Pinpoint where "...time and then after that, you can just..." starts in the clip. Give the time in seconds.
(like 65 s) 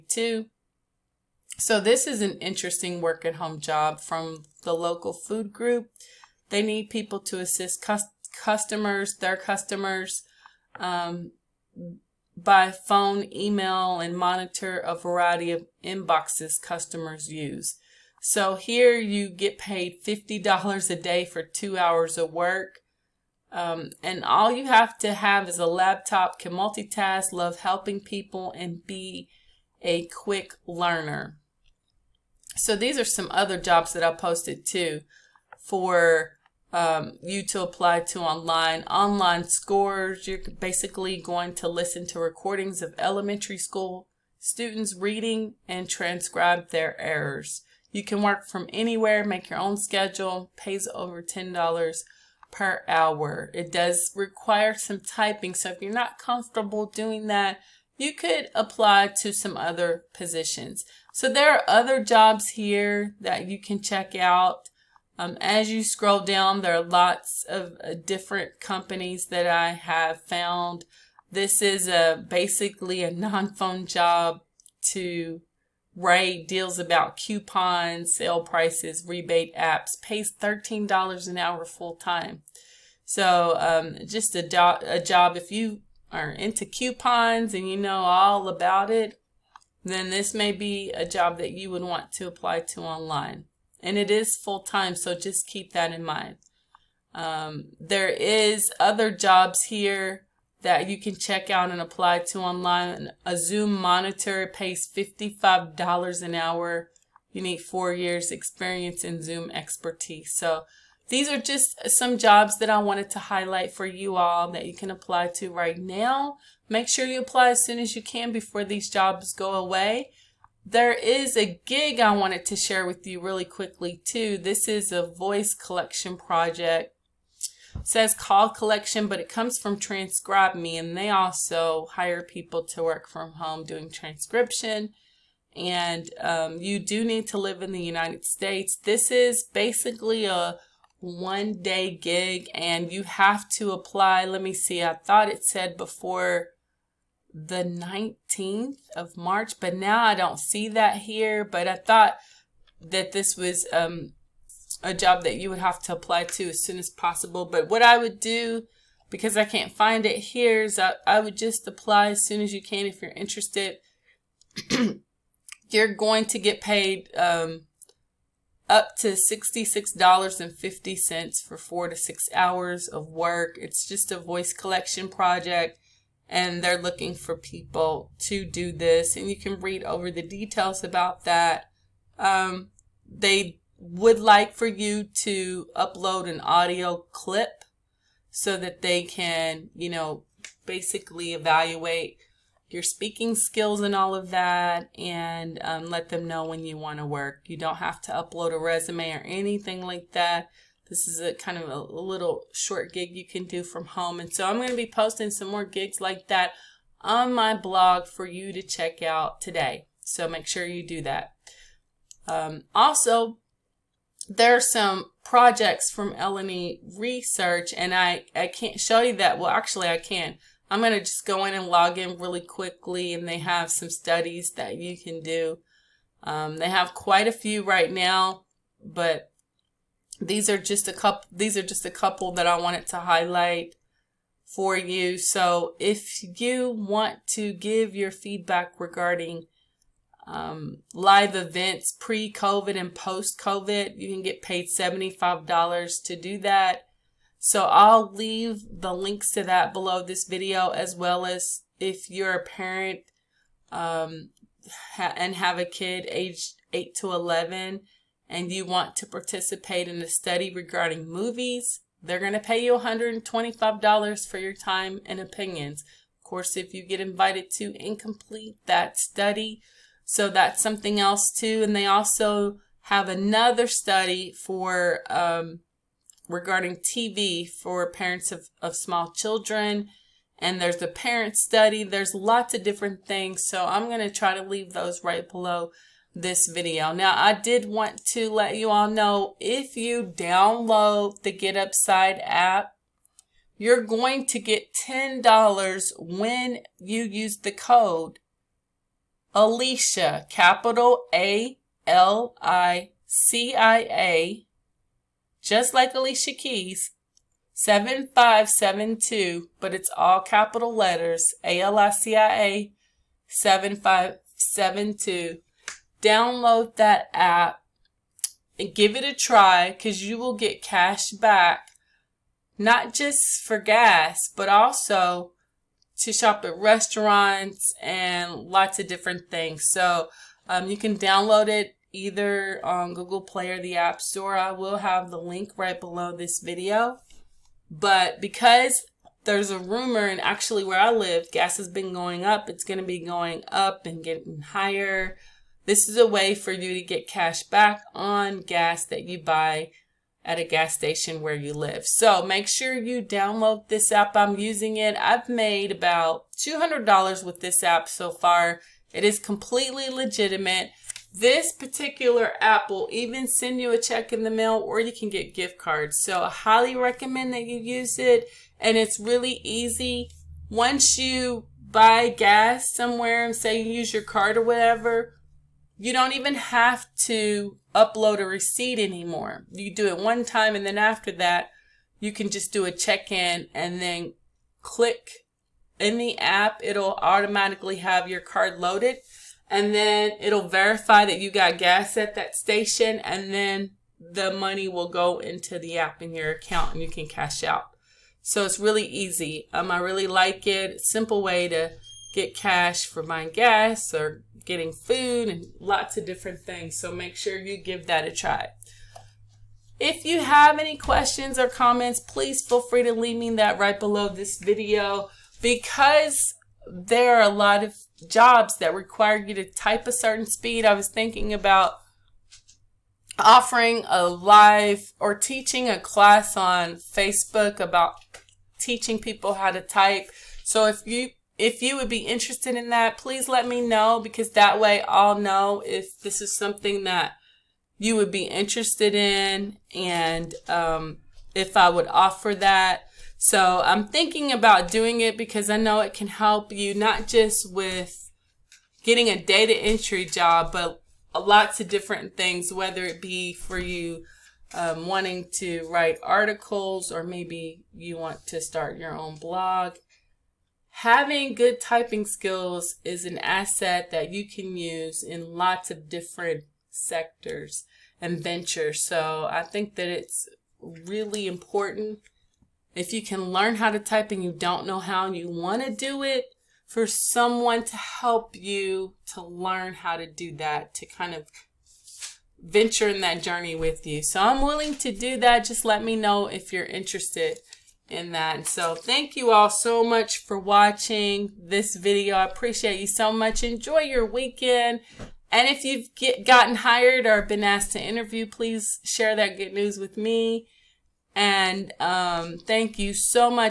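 380 s.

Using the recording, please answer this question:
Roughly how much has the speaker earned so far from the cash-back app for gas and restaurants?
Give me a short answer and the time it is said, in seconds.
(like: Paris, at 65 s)
$200, at 356 s.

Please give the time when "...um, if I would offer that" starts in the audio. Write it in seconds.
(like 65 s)
440 s.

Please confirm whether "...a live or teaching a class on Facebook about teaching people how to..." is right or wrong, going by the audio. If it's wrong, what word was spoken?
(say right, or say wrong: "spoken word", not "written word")
right.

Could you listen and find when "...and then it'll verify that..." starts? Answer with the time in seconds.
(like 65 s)
389 s.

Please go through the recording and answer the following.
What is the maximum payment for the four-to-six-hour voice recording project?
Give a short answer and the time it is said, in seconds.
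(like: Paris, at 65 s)
$66.50, at 169 s.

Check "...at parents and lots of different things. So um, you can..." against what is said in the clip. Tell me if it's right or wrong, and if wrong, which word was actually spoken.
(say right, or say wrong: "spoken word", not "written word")
wrong: "restaurants", not "parents".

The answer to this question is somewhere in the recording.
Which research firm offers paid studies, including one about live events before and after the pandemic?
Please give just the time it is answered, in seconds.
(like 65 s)
216 s.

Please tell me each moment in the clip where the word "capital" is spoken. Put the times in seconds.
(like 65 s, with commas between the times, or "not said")
300 s, 310 s.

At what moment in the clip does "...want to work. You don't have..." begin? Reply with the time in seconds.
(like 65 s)
196 s.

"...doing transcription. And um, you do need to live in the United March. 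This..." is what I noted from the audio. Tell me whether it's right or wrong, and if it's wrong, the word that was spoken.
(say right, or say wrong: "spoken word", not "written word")
wrong: "States", not "March".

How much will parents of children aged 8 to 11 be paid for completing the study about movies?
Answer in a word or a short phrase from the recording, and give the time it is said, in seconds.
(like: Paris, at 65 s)
$125, at 262 s.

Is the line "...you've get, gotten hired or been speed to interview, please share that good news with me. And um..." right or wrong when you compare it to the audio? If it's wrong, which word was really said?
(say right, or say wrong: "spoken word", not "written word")
wrong: "asked", not "speed".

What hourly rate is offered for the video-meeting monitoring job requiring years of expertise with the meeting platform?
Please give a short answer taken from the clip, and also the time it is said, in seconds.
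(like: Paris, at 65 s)
$55 an hour, at 104 s.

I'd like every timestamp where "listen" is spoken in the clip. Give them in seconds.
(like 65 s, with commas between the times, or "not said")
41 s.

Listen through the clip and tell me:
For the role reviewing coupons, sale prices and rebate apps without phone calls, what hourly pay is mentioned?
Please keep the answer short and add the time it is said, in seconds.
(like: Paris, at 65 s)
$13 an hour, at 80 s.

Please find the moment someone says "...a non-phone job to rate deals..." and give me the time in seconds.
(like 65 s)
73 s.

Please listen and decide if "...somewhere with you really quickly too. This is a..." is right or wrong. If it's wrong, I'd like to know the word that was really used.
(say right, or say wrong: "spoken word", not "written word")
wrong: "share", not "somewhere".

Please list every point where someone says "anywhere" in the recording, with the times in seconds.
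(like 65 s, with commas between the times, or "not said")
48 s.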